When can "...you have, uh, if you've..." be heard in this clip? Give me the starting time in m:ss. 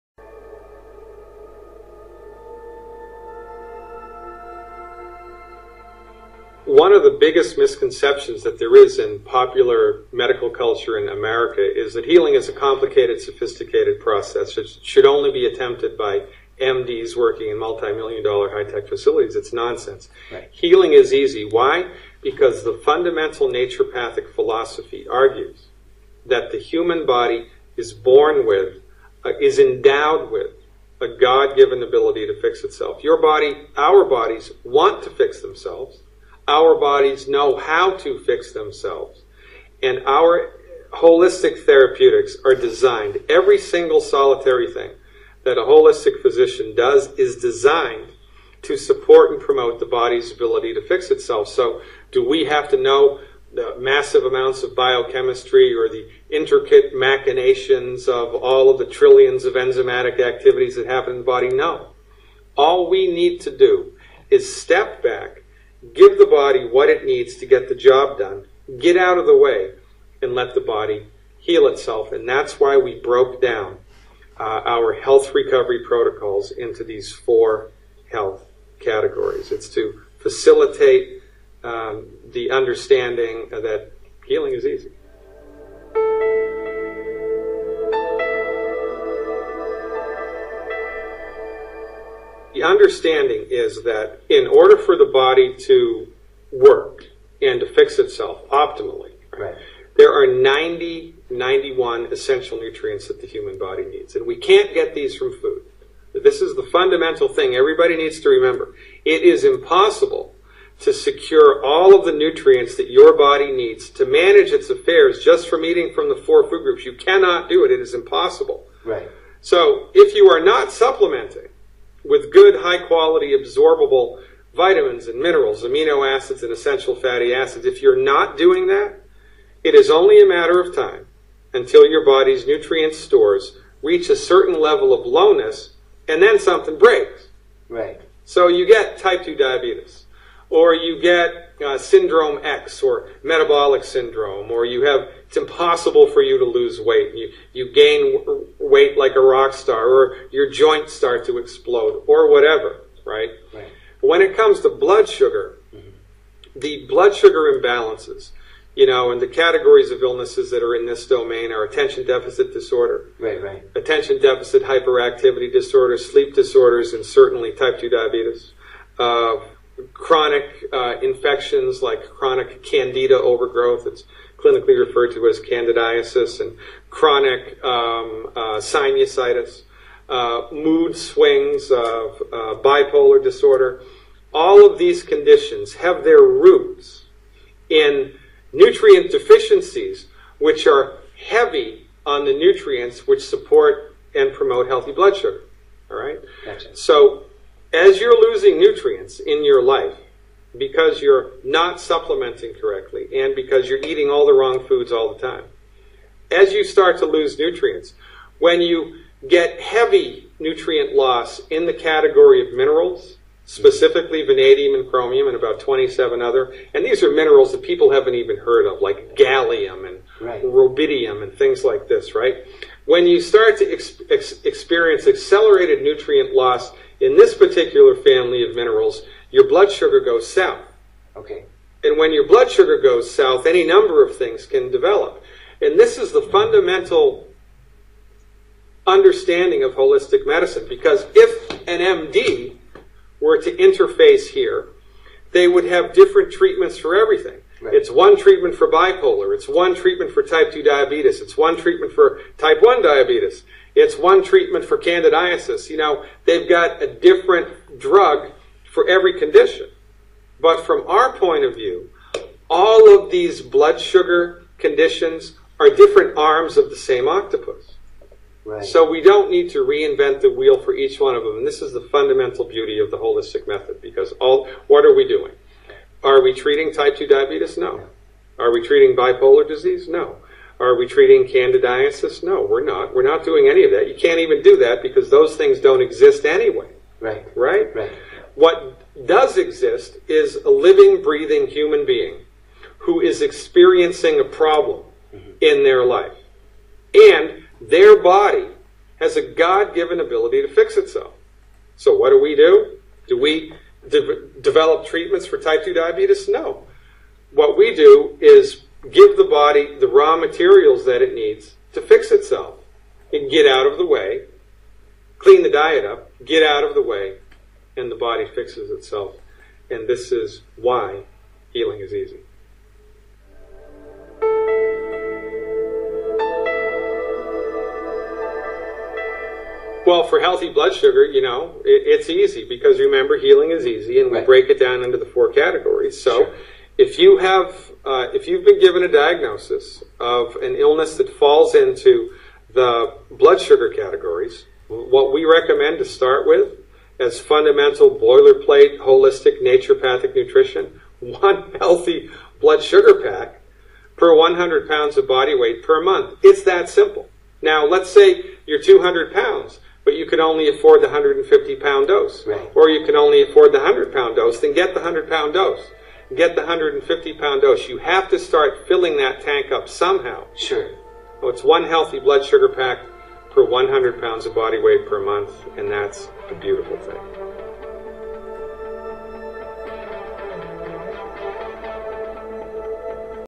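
5:36.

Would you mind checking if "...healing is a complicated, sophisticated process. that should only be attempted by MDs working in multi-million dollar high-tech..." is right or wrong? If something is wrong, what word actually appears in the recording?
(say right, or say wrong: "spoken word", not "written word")
right.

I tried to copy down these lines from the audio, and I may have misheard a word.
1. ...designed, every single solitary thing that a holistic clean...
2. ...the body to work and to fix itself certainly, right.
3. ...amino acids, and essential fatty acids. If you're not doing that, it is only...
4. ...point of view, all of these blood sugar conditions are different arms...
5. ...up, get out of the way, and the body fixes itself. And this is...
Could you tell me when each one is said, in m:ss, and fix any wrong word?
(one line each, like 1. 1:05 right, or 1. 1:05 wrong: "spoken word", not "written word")
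1. 0:42 wrong: "physician", not "clean"
2. 1:34 wrong: "optimally", not "certainly"
3. 2:05 right
4. 4:21 right
5. 5:15 right.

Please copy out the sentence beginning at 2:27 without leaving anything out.
You you gain weight like a rock star, or your joints start to explode, or whatever.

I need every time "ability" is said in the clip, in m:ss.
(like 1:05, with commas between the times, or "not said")
0:31, 0:50, 4:59.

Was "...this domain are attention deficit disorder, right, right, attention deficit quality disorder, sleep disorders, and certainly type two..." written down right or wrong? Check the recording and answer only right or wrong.
wrong.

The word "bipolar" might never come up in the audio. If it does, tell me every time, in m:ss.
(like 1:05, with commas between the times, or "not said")
3:02, 4:08, 4:38.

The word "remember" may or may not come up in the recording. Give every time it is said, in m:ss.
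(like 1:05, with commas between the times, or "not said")
1:48, 5:32.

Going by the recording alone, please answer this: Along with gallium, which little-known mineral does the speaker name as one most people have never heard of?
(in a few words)
rubidium.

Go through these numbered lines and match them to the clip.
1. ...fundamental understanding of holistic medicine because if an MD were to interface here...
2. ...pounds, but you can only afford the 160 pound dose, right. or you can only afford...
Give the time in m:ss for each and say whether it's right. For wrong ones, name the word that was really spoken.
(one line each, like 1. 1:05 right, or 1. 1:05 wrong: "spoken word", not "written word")
1. 3:56 right
2. 5:59 wrong: "150", not "160".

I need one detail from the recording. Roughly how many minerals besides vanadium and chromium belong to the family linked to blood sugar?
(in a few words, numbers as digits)
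27.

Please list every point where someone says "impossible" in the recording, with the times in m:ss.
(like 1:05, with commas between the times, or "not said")
1:49, 1:57, 2:25.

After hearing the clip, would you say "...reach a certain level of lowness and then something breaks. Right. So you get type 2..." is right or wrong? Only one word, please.
right.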